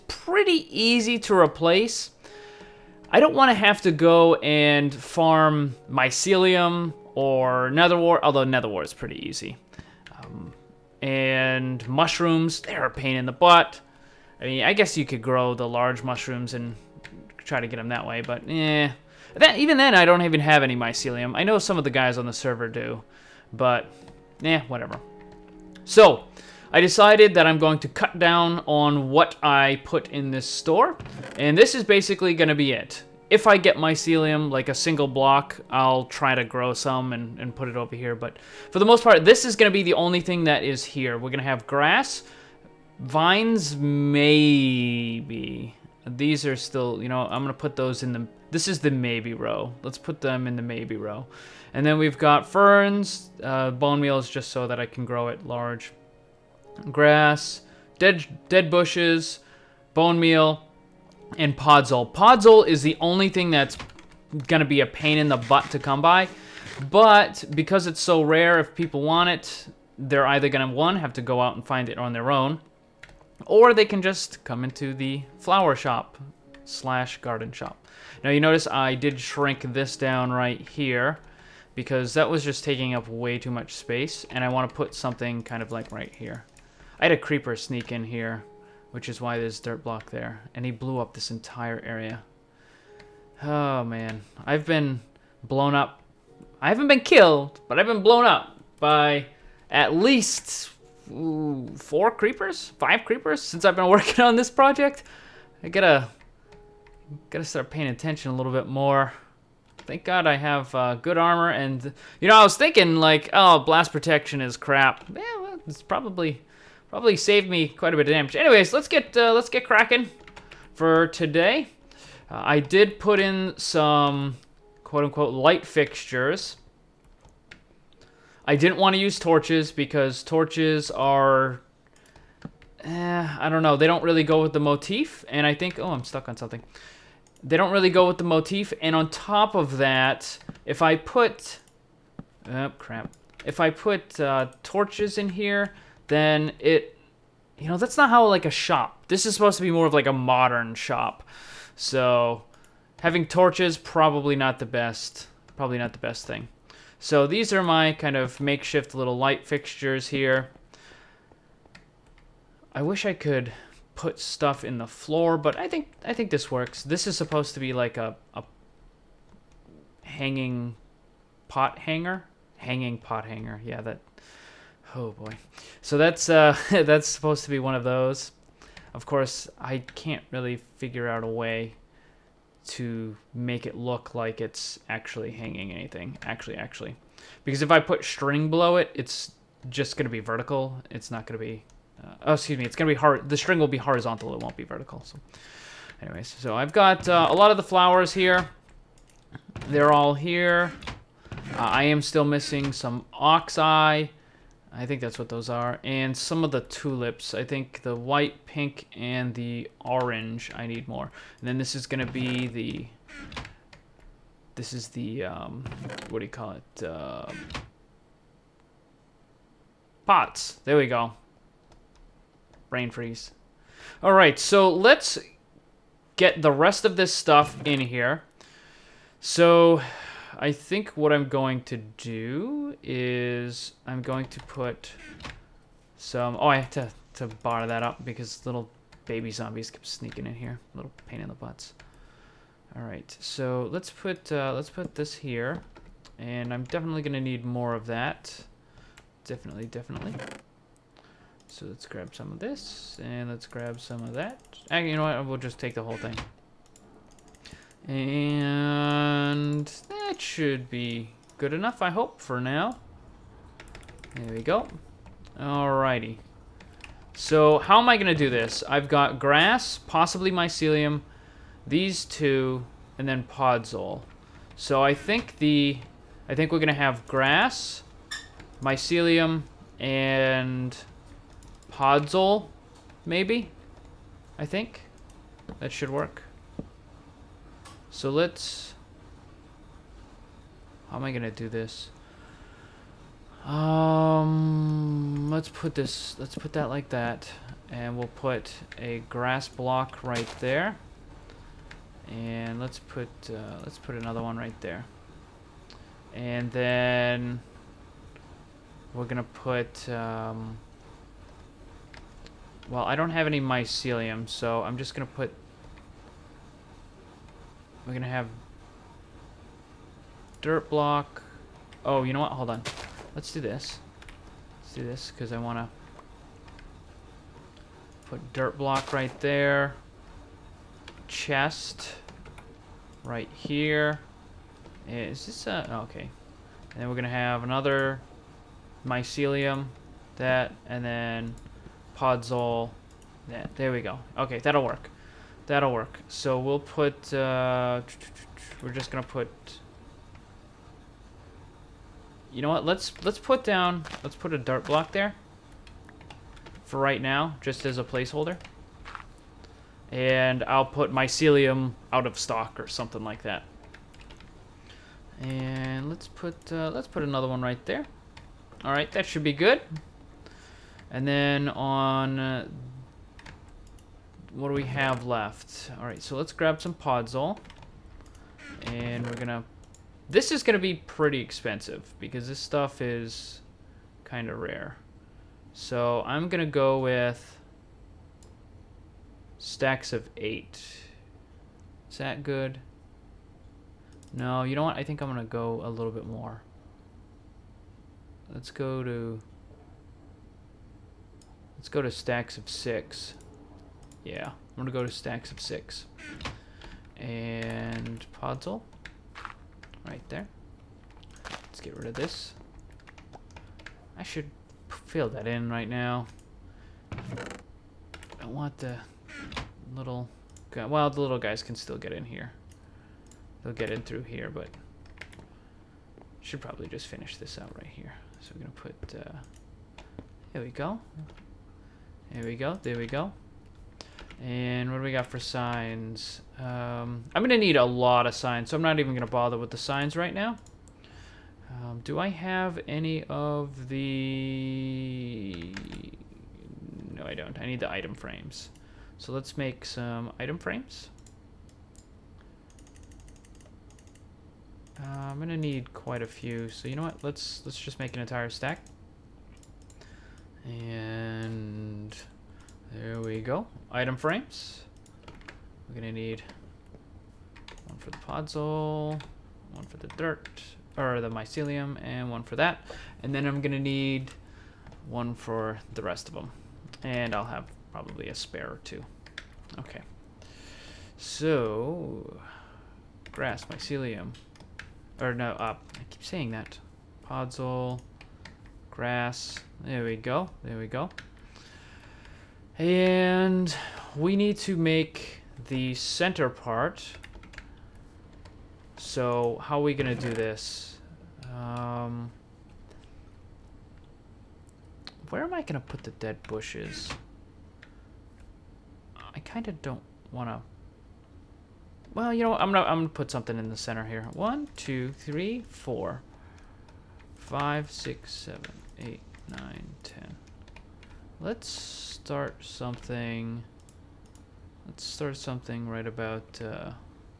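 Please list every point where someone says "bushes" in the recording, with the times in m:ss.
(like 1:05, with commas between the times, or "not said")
0:58, 8:26.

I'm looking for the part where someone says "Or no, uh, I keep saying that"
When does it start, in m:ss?
8:05.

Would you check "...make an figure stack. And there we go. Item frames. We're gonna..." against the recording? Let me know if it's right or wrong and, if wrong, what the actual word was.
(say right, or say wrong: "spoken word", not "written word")
wrong: "entire", not "figure".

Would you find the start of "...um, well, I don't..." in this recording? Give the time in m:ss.
5:09.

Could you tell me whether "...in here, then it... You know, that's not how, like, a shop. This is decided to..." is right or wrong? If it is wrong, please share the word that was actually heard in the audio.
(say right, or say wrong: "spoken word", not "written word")
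wrong: "supposed", not "decided".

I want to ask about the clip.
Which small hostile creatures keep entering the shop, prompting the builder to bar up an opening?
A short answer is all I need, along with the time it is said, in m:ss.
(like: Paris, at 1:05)
Baby zombies, at 3:58.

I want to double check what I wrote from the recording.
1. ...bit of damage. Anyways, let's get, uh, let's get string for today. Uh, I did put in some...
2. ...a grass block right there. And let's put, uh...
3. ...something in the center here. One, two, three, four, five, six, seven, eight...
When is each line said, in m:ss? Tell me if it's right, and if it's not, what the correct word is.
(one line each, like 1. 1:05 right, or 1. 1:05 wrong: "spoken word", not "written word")
1. 1:57 wrong: "cracking", not "string"
2. 4:58 right
3. 8:33 right.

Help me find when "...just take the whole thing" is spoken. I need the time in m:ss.
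4:15.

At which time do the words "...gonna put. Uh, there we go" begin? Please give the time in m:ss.
7:08.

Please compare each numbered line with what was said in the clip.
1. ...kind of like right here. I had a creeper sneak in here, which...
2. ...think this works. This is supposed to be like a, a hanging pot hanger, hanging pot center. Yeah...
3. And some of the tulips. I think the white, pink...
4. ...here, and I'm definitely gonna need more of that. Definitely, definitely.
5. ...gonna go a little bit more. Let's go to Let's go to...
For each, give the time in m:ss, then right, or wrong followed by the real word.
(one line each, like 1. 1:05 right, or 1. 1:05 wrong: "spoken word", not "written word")
1. 1:25 right
2. 2:46 wrong: "hanger", not "center"
3. 3:25 right
4. 4:05 right
5. 6:35 right.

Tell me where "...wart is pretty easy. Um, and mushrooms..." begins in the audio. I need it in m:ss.
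0:08.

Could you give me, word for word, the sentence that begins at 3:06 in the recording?
Actually, actually, because if I put string below it, it's just gonna be vertical.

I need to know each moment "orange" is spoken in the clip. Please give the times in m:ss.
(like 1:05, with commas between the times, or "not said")
3:29.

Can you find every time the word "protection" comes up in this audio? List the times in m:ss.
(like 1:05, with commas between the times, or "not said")
1:53.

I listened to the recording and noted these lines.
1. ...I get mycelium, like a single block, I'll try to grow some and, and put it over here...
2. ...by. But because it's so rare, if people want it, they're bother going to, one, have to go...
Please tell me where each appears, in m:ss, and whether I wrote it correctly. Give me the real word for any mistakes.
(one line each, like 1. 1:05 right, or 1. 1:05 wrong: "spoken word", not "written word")
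1. 0:33 right
2. 1:06 wrong: "either", not "bother".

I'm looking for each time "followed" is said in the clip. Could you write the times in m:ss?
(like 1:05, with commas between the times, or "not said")
not said.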